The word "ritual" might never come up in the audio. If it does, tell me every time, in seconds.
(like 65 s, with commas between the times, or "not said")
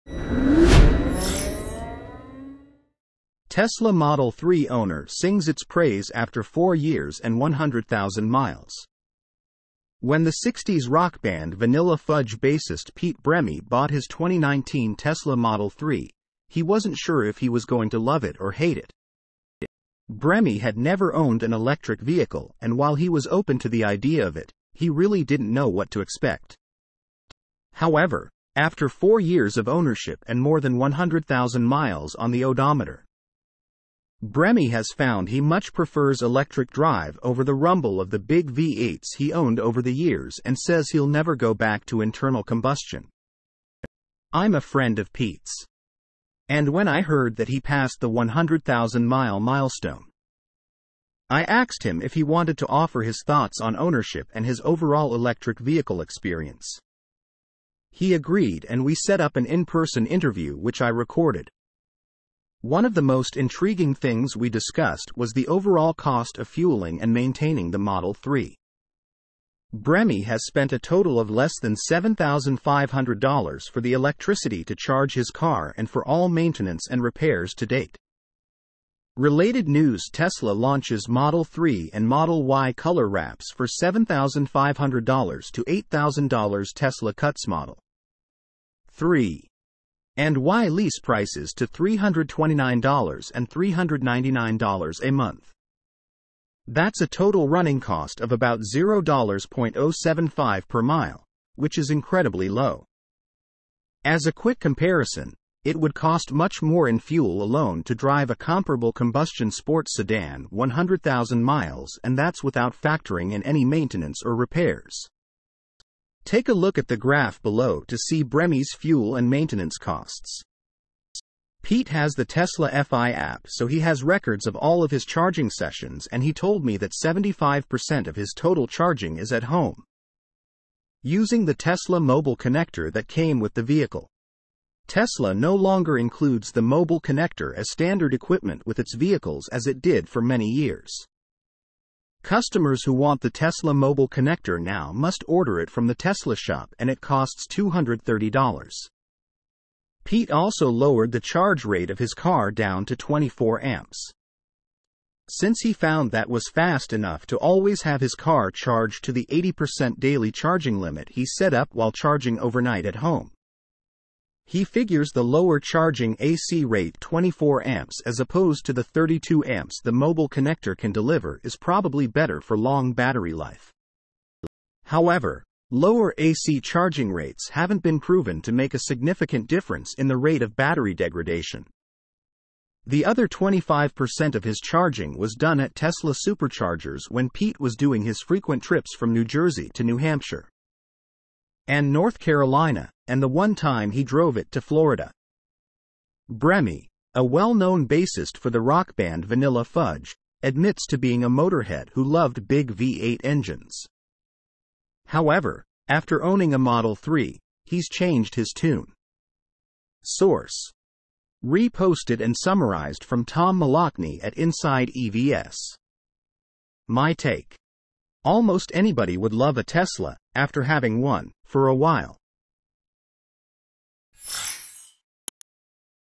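not said.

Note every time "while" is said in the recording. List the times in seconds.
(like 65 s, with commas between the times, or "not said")
22 s, 161 s, 221 s.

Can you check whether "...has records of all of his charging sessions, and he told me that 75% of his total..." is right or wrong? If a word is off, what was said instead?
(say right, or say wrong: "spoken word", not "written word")
right.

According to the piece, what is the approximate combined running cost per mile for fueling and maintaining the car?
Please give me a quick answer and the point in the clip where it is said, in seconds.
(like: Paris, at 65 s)
$0.075, at 98 s.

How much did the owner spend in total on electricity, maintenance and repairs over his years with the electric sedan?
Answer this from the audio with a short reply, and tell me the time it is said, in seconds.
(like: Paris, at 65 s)
less than $7,500, at 71 s.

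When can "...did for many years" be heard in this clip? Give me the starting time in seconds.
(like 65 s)
139 s.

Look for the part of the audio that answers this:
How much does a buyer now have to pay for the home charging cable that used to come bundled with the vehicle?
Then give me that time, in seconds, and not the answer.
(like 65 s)
147 s.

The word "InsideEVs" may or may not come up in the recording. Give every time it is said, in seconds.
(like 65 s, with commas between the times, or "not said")
214 s.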